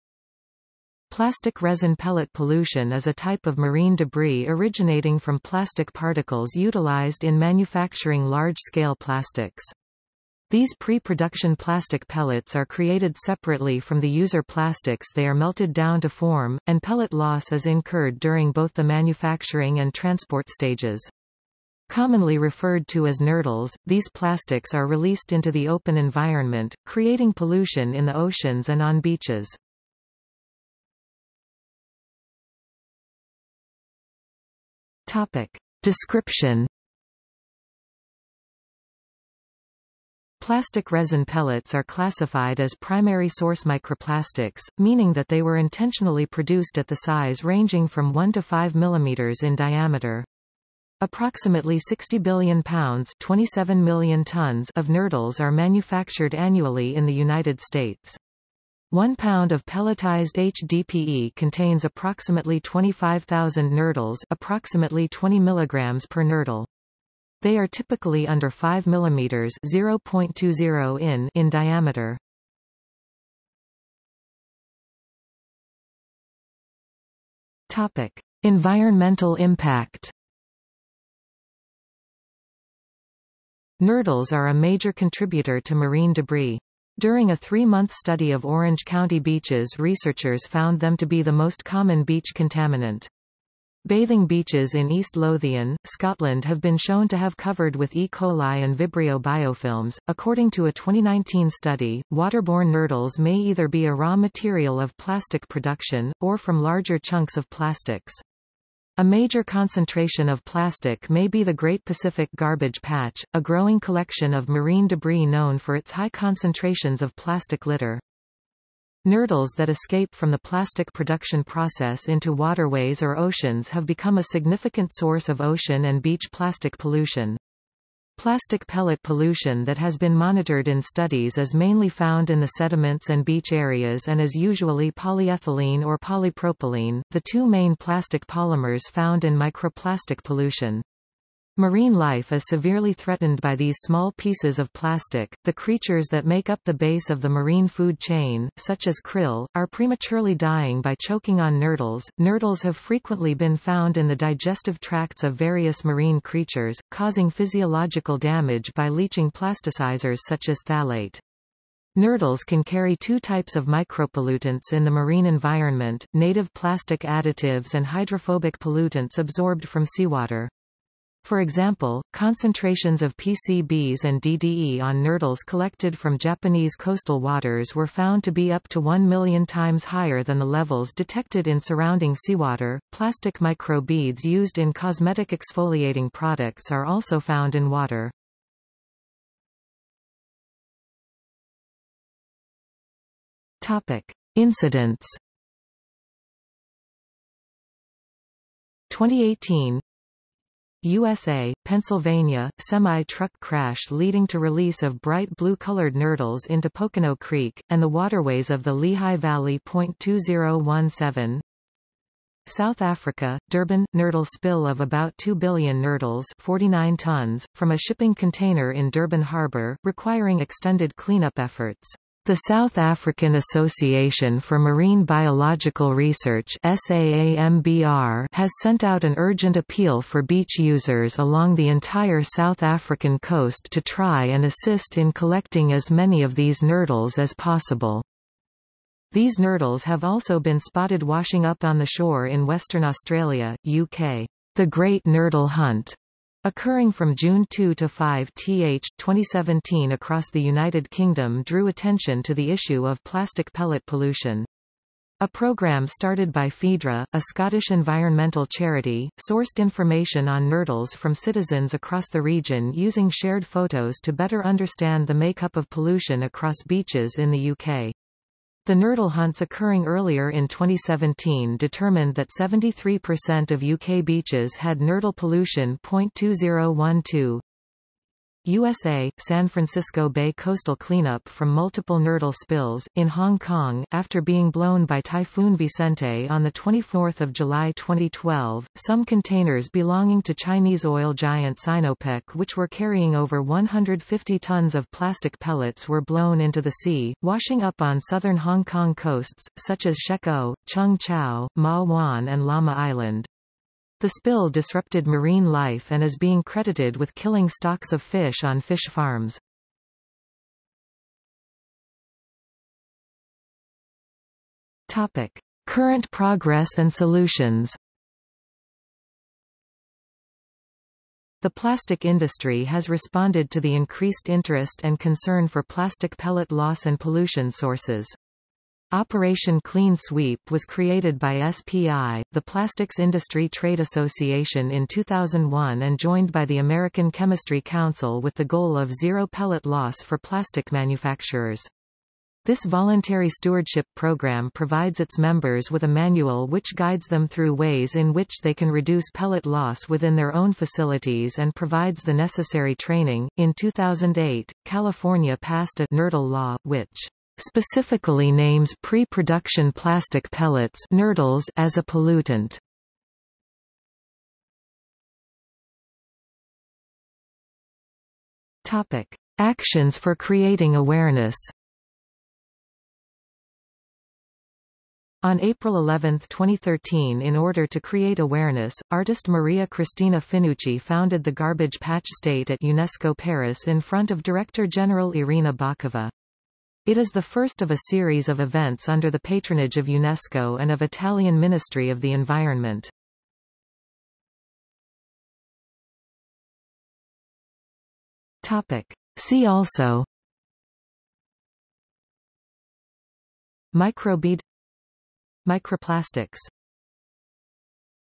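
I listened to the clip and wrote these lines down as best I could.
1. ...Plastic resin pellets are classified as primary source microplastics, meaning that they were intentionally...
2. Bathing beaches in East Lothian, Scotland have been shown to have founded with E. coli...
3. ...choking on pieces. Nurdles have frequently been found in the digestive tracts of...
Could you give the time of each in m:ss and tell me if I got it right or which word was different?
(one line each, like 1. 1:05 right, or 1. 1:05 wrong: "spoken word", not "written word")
1. 0:40 right
2. 1:33 wrong: "covered", not "founded"
3. 2:31 wrong: "nurdles", not "pieces".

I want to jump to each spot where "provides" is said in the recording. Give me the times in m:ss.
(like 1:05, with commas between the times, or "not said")
5:44, 5:51.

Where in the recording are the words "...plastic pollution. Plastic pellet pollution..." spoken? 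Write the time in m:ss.
2:06.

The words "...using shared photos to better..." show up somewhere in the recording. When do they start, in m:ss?
4:22.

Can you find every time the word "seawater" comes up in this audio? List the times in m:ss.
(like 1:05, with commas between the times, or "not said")
2:49, 3:02.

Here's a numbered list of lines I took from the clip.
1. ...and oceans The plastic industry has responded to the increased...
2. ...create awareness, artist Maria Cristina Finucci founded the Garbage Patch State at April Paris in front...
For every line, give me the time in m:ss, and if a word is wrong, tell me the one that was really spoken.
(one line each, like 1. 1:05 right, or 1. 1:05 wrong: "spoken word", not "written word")
1. 5:16 wrong: "solutions", not "oceans"
2. 6:17 wrong: "UNESCO", not "April".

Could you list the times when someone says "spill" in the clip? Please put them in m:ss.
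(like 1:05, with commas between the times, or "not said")
3:34, 4:42, 5:04.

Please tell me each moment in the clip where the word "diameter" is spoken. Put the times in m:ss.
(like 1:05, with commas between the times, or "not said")
0:49, 1:11.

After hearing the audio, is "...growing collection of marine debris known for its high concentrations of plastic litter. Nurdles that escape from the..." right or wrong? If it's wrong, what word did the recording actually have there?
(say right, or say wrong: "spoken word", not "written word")
right.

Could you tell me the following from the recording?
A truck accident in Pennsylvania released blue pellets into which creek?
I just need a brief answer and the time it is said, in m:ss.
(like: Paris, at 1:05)
Pocono Creek, at 3:26.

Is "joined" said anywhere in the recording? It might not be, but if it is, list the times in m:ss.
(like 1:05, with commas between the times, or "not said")
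5:35.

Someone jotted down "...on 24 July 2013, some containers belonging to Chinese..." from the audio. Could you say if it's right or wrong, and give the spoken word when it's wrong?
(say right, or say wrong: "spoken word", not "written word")
wrong: "2012", not "2013".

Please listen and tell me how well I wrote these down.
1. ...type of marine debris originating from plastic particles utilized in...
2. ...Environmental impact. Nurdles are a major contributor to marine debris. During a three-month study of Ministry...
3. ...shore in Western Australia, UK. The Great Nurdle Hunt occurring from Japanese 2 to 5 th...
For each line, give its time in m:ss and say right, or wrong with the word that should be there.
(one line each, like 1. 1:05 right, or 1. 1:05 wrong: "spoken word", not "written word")
1. 0:03 right
2. 1:18 wrong: "Orange", not "Ministry"
3. 4:01 wrong: "June", not "Japanese".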